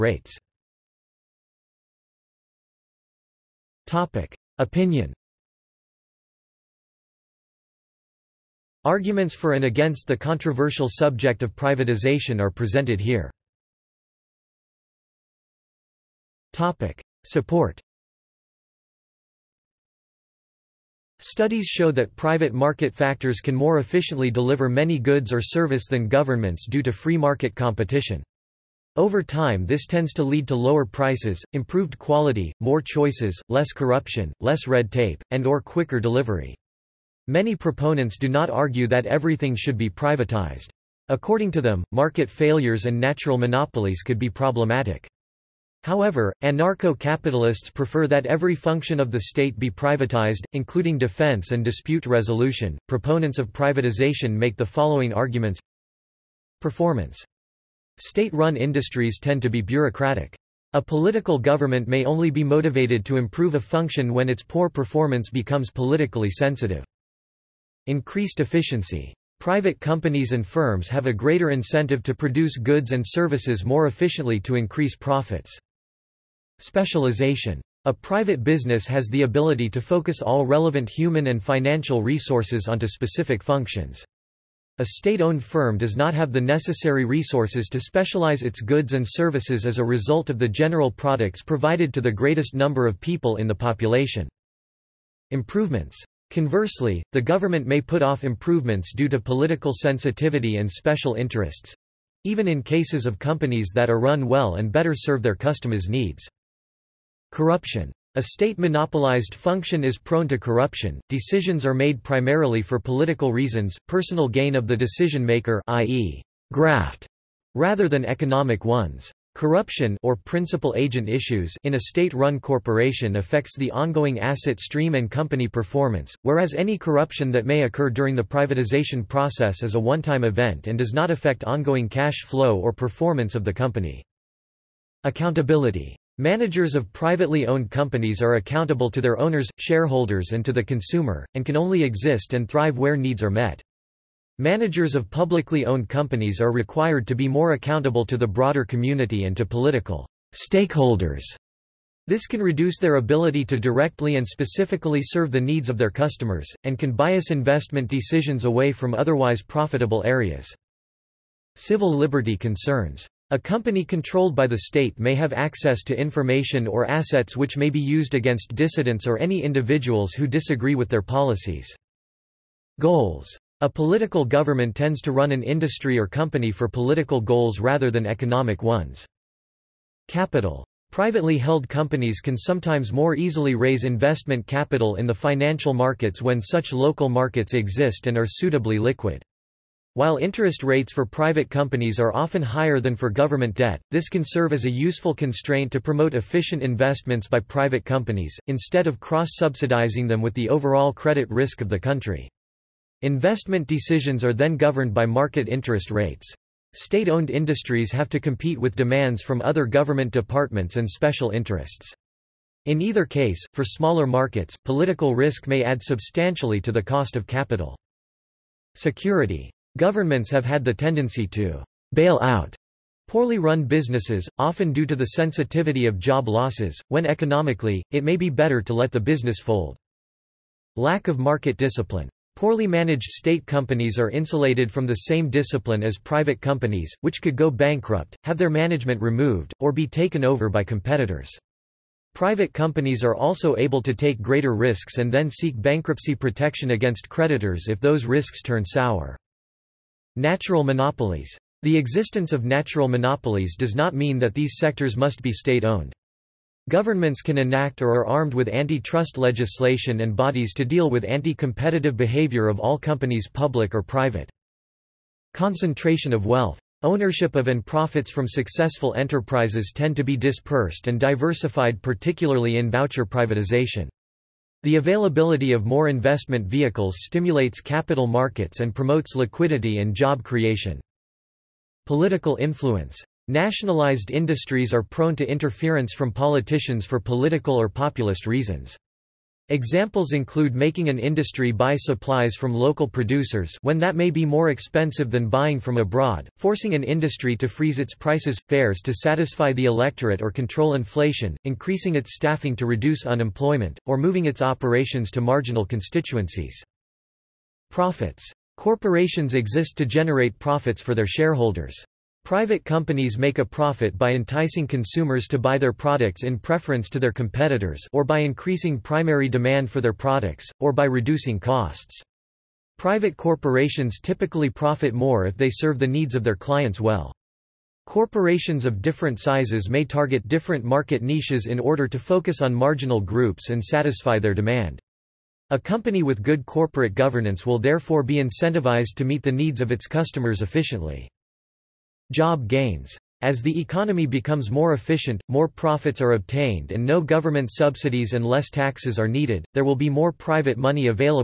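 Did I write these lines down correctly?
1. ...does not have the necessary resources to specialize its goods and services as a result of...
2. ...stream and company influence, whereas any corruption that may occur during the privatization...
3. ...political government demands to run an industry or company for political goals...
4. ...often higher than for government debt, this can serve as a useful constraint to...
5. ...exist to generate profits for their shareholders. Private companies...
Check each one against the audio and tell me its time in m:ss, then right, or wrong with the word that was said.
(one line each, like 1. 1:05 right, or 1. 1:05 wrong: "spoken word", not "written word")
1. 1:25 right
2. 2:04 wrong: "performance", not "influence"
3. 2:53 wrong: "tends", not "demands"
4. 3:12 right
5. 5:09 right.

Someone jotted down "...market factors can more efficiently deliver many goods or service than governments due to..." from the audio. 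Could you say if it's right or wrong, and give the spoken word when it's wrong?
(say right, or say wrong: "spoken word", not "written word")
right.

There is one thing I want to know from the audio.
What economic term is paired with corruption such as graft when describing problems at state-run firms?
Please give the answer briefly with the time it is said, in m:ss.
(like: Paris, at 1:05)
Principal agent issues, at 2:00.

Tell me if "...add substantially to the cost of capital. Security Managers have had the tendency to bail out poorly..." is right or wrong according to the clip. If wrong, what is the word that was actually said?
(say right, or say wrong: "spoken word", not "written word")
wrong: "Governments", not "Managers".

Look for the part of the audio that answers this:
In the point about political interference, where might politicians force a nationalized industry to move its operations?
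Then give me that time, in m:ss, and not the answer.
5:05.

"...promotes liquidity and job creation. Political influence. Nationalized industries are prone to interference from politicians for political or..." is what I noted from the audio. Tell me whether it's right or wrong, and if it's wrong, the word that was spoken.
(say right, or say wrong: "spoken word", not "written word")
right.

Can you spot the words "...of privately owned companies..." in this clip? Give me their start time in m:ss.
2:16.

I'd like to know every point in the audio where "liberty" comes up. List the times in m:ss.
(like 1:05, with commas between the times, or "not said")
2:41.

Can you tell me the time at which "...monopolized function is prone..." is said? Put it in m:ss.
1:48.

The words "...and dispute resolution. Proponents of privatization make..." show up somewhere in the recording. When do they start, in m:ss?
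0:51.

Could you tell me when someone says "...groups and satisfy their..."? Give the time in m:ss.
5:32.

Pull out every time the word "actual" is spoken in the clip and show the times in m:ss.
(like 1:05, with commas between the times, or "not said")
not said.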